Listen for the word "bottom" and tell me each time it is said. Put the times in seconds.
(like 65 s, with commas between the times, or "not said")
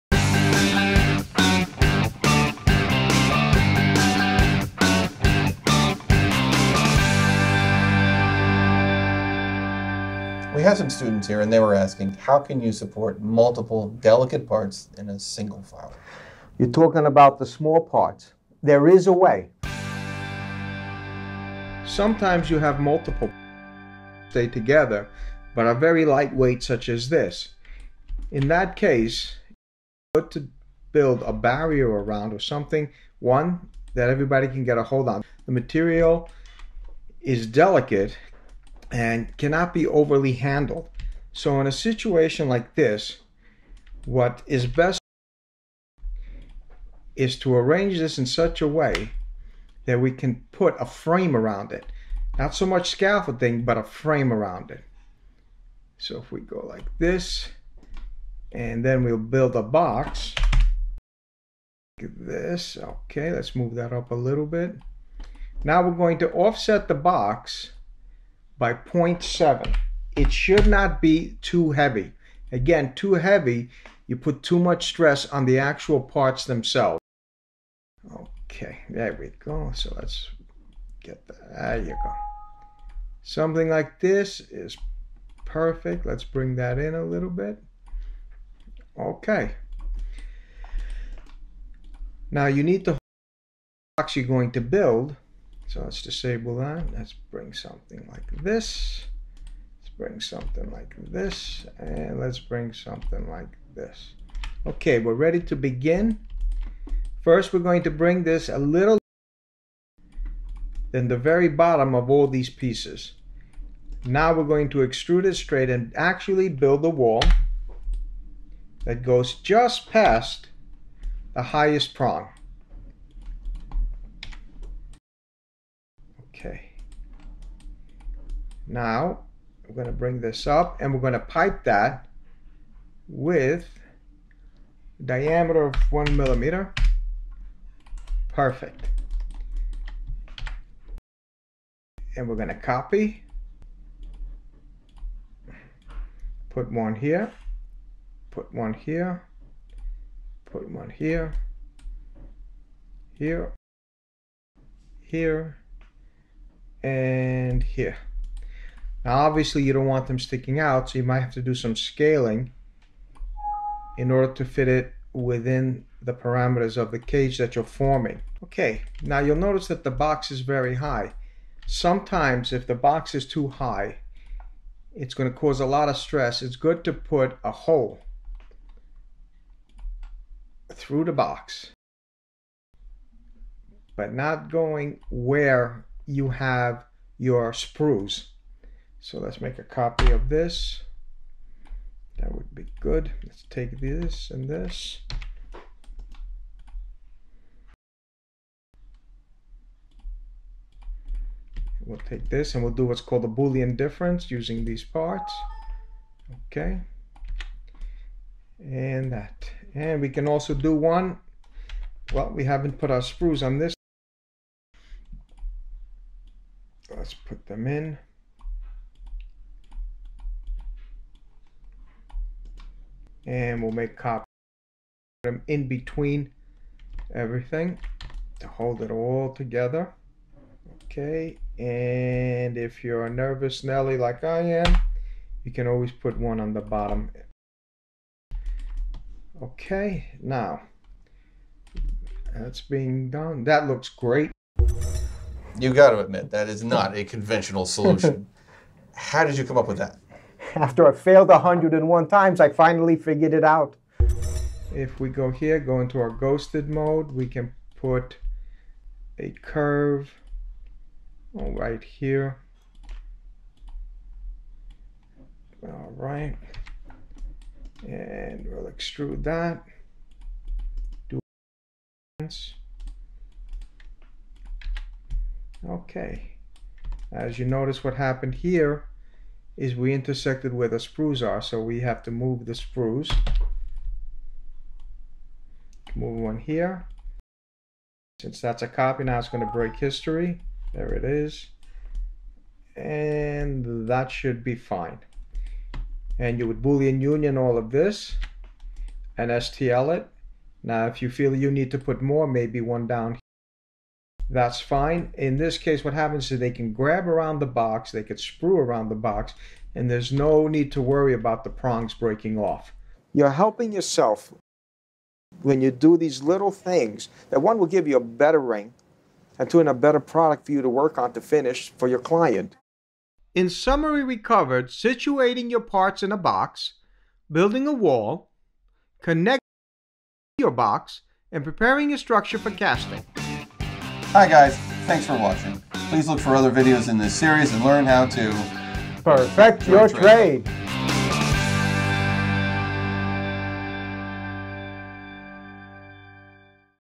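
111 s, 236 s.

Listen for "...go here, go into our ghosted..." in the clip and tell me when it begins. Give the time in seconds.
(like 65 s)
255 s.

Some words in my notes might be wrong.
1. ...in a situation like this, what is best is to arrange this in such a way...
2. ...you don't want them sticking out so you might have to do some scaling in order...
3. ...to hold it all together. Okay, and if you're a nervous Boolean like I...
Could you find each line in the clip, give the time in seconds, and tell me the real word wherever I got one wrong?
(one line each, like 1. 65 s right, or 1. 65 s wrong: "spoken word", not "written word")
1. 41 s right
2. 159 s right
3. 228 s wrong: "Nelly", not "Boolean".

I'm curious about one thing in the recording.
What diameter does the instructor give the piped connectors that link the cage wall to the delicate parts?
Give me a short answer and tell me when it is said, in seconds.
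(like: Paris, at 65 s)
1 millimeter, at 135 s.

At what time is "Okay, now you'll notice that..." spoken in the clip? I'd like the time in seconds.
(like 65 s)
168 s.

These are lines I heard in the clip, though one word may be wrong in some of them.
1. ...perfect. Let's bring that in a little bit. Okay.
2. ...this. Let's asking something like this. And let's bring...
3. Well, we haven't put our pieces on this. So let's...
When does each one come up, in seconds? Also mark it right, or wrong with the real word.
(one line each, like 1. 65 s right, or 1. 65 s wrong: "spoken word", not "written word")
1. 85 s right
2. 98 s wrong: "bring", not "asking"
3. 212 s wrong: "sprues", not "pieces".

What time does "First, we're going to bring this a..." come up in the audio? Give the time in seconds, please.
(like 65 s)
107 s.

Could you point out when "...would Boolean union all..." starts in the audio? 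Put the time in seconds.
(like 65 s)
296 s.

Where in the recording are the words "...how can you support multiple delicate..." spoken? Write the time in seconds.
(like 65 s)
12 s.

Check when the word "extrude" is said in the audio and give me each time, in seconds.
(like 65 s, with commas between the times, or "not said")
114 s, 268 s.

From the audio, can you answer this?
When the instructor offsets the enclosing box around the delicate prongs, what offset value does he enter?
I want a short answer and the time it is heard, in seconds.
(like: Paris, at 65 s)
0.7, at 68 s.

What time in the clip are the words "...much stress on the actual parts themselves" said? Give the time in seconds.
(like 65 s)
74 s.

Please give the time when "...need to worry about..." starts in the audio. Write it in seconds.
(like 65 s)
310 s.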